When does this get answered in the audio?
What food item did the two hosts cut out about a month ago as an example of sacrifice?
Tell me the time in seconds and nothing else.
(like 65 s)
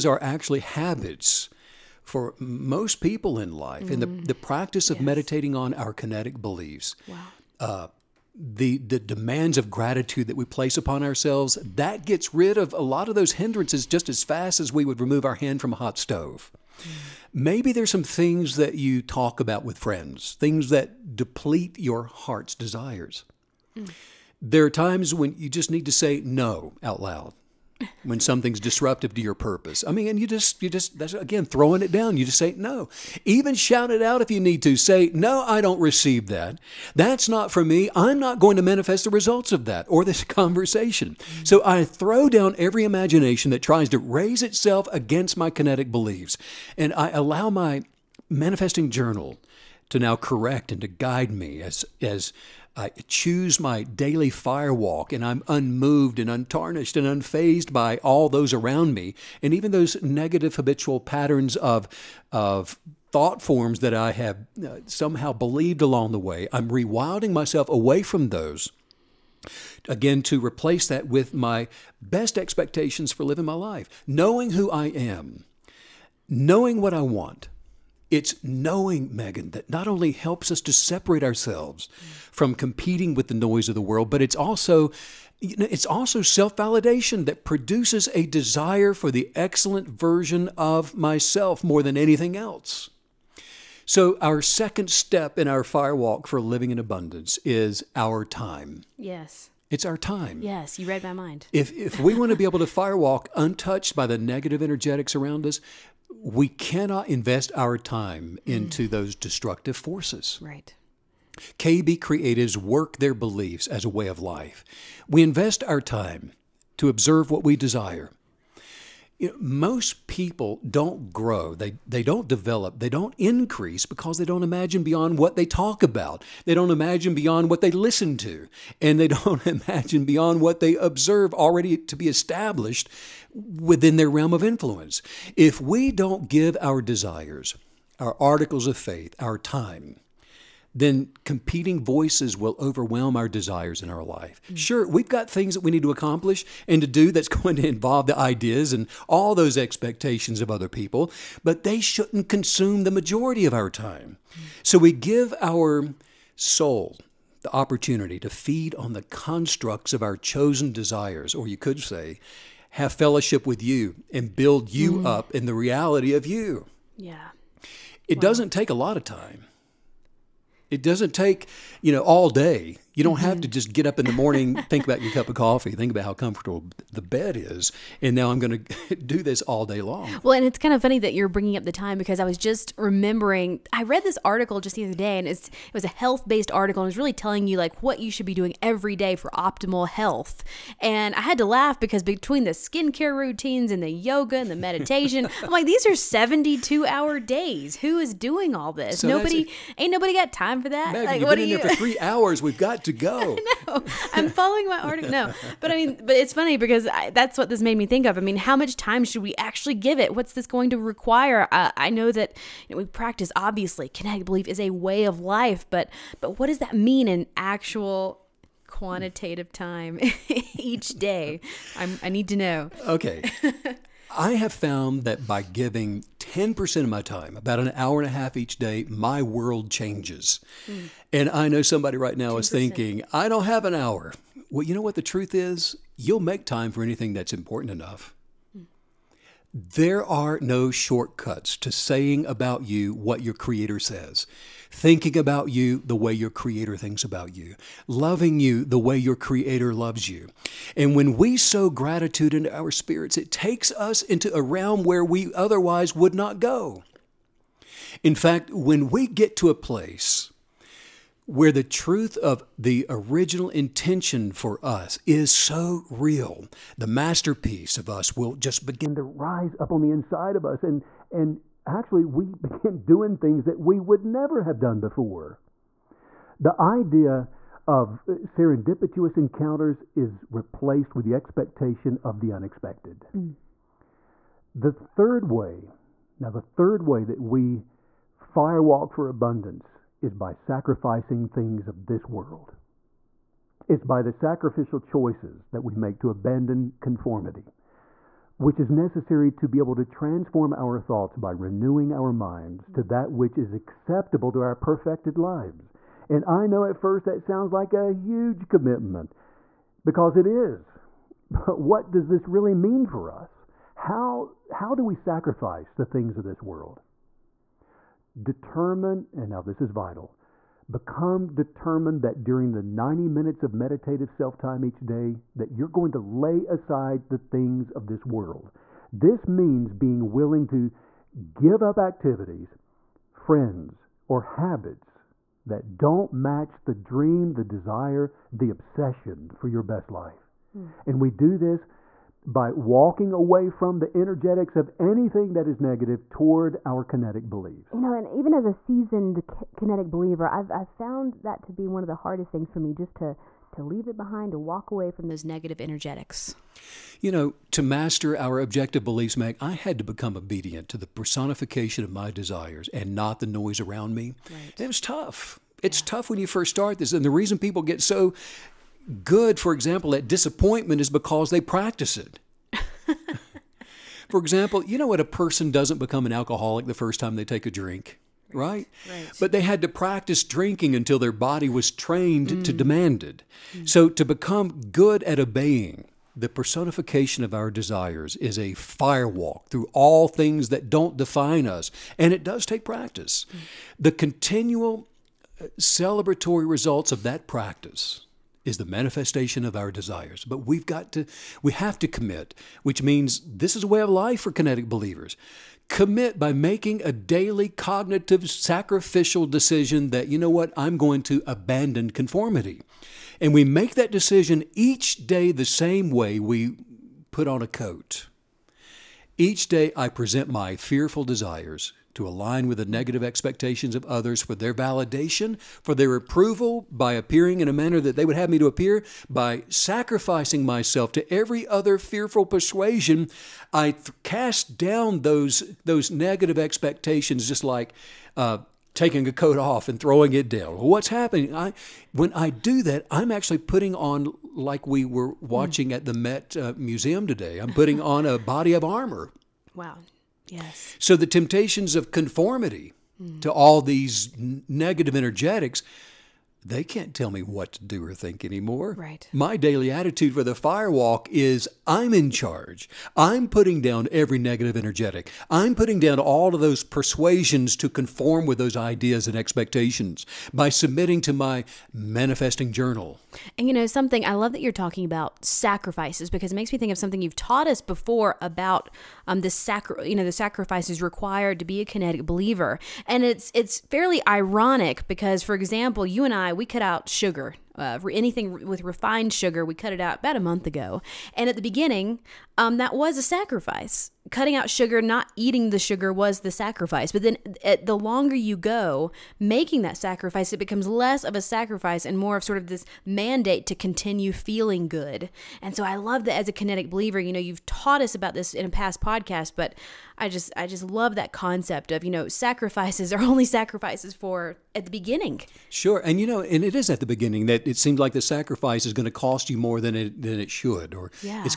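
488 s.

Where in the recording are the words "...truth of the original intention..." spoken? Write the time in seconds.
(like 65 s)
261 s.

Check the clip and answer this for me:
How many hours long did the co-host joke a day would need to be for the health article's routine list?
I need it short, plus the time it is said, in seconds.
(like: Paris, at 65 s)
72, at 195 s.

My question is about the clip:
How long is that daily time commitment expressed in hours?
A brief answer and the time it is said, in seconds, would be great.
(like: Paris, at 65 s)
an hour and a half, at 227 s.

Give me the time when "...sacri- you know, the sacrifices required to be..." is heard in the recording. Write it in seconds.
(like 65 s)
479 s.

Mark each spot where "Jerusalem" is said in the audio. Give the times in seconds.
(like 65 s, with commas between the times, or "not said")
not said.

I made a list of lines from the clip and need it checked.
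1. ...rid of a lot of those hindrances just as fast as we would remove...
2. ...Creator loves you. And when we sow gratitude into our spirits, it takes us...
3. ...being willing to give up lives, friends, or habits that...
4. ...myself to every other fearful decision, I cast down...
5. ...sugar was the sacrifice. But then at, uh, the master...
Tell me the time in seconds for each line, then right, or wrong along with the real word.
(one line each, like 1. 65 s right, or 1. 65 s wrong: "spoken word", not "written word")
1. 12 s right
2. 249 s right
3. 329 s wrong: "activities", not "lives"
4. 430 s wrong: "persuasion", not "decision"
5. 495 s wrong: "longer", not "master".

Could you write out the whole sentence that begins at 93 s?
So our second step in our firewalk for living in abundance is our time.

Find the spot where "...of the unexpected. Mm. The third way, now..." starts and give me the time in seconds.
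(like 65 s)
282 s.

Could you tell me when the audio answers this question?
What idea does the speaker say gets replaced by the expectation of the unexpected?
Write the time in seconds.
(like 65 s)
278 s.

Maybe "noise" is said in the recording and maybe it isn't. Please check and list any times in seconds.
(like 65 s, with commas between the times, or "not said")
83 s, 363 s.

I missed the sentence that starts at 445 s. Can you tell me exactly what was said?
watching at the Met uh, Museum today, I'm putting on a body of armor.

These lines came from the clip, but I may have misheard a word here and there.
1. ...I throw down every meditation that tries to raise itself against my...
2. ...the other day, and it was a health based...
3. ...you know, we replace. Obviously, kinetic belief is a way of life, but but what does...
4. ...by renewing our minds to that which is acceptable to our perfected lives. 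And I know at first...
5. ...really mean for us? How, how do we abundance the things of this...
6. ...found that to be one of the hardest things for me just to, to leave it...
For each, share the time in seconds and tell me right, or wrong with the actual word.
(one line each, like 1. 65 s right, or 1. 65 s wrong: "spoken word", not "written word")
1. 41 s wrong: "imagination", not "meditation"
2. 184 s right
3. 212 s wrong: "practice", not "replace"
4. 301 s right
5. 312 s wrong: "sacrifice", not "abundance"
6. 350 s right.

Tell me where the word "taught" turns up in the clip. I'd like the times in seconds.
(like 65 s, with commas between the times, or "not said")
477 s, 507 s.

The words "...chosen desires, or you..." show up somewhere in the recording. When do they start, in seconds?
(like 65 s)
160 s.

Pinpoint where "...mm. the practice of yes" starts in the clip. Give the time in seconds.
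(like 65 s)
4 s.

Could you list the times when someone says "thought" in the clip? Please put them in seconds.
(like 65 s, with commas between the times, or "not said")
63 s, 300 s.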